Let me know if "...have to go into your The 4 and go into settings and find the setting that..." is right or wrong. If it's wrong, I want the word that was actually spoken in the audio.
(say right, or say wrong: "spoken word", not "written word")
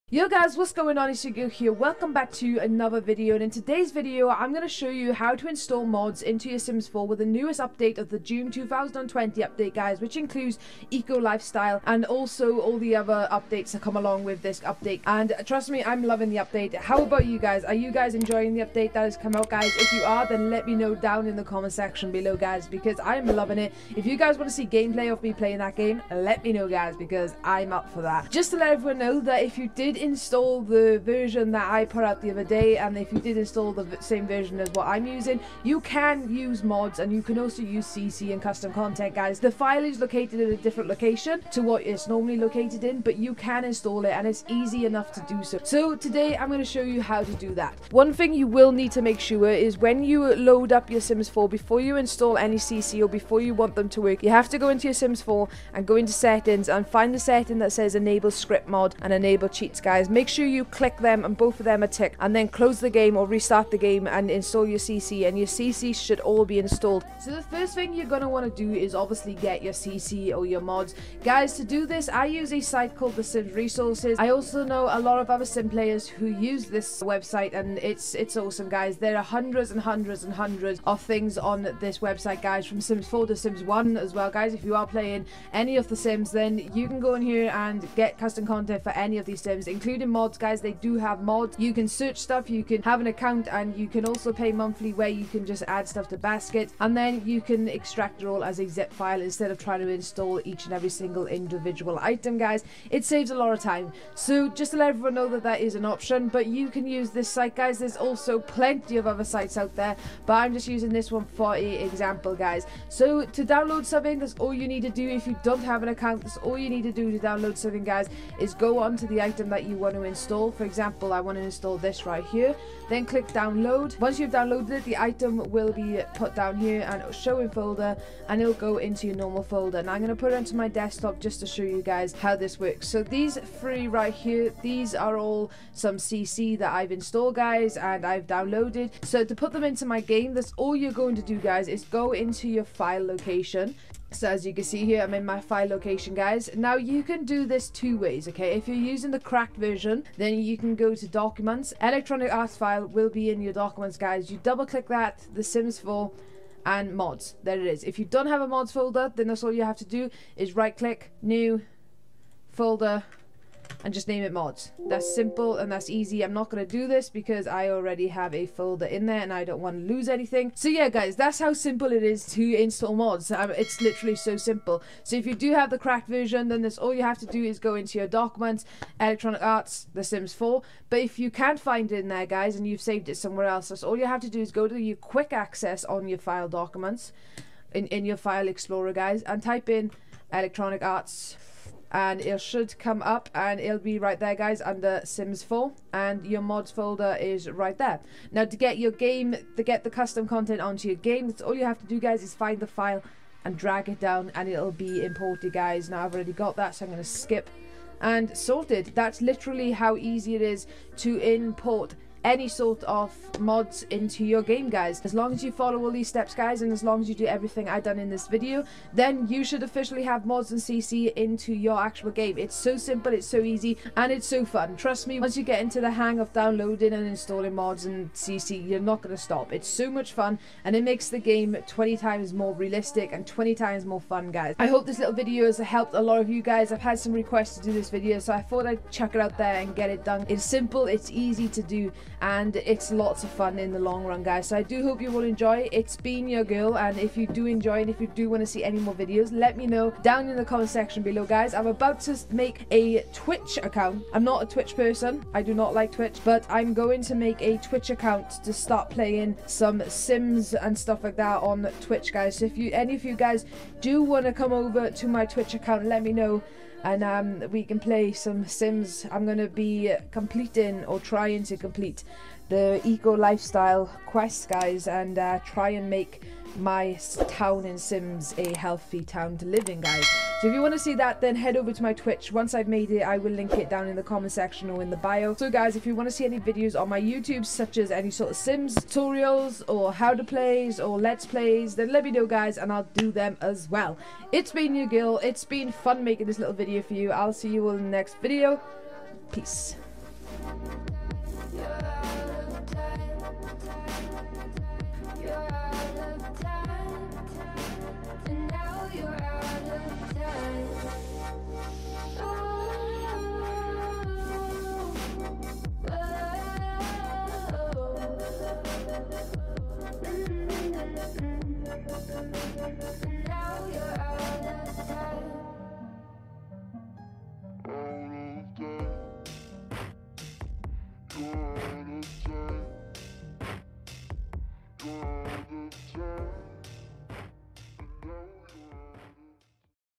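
wrong: "Sims", not "The".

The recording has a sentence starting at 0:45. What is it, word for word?
So today, I'm going to show you how to do that.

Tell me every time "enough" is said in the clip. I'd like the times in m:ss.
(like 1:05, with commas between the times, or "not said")
0:44.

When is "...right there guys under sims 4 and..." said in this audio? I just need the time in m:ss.
3:13.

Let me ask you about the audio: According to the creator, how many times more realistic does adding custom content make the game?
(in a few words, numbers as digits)
20.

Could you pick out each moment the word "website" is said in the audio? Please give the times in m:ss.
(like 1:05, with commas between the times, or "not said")
1:17, 1:22.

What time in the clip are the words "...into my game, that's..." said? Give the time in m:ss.
2:19.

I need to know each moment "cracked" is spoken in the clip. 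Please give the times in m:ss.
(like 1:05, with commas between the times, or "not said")
2:29, 2:55.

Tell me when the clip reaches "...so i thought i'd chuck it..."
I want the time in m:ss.
3:58.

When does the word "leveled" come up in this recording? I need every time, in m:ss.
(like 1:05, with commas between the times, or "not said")
not said.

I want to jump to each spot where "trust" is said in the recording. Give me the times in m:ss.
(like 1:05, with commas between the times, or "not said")
0:15, 3:44.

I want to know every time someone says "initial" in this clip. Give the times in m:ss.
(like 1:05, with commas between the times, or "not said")
not said.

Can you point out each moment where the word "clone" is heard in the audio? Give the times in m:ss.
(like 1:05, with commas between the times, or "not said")
not said.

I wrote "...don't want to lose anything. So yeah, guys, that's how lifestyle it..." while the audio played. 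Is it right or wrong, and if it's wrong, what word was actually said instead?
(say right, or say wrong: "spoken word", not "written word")
wrong: "simple", not "lifestyle".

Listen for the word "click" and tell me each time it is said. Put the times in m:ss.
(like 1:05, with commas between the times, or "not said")
1:00, 2:03, 2:34, 2:40.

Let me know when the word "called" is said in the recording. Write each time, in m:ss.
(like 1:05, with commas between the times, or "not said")
1:12.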